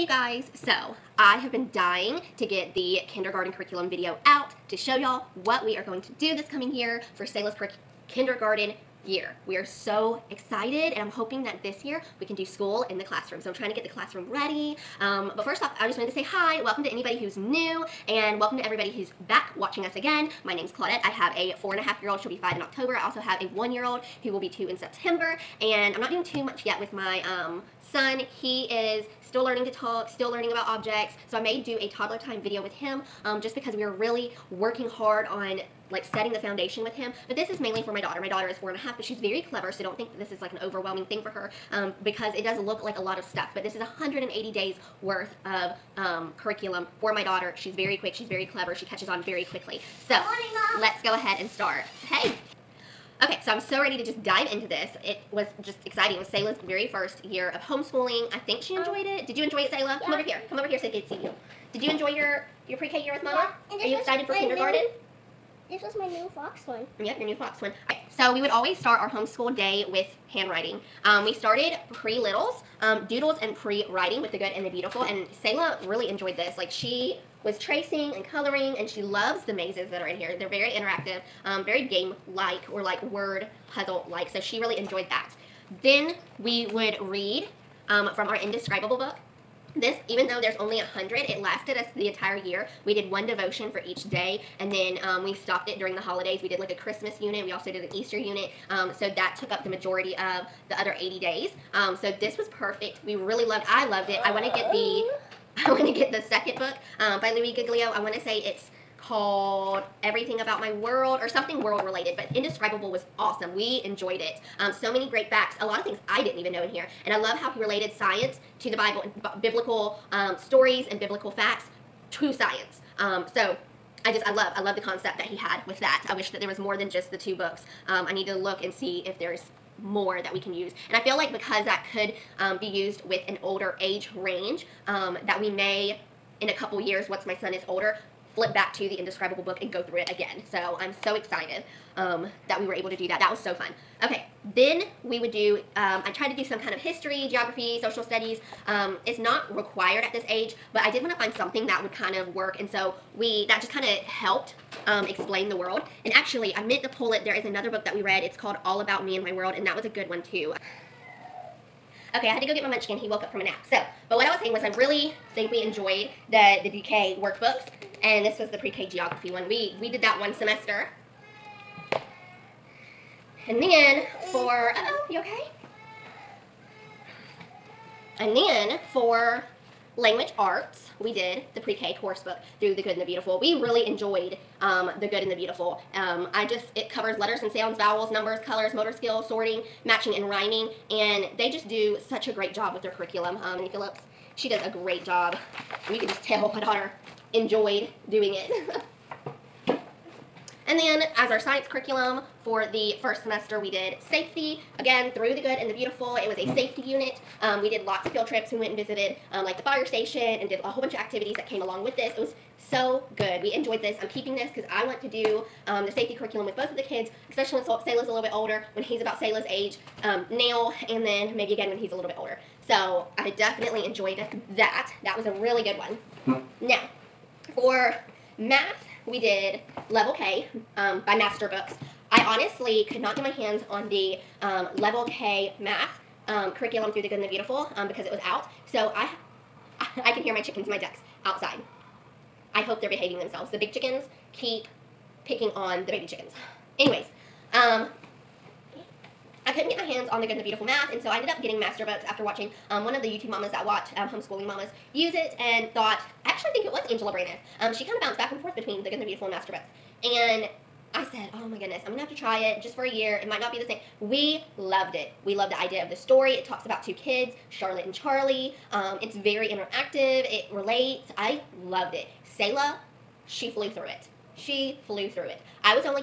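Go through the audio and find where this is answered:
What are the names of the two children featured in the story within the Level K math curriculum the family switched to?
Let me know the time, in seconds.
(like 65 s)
267 s.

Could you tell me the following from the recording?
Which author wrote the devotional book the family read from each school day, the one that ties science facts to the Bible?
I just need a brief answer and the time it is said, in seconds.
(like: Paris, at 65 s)
Louie Giglio, at 107 s.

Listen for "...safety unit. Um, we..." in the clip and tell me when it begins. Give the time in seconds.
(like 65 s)
206 s.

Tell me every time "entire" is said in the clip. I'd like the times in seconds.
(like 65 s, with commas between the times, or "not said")
92 s.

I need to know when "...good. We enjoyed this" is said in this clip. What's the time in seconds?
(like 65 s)
213 s.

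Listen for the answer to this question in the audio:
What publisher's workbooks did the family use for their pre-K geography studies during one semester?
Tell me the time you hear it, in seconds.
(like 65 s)
166 s.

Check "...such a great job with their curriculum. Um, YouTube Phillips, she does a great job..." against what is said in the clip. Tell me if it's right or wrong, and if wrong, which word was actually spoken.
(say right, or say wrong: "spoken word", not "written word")
wrong: "Jenny", not "YouTube".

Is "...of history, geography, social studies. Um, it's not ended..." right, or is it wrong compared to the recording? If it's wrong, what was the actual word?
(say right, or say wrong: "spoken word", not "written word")
wrong: "required", not "ended".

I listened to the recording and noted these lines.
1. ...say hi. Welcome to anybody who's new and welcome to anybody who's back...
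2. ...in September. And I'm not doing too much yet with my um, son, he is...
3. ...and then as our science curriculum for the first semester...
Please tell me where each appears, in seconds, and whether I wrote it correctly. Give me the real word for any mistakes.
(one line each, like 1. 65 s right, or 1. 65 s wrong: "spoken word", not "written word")
1. 16 s wrong: "everybody", not "anybody"
2. 24 s right
3. 199 s right.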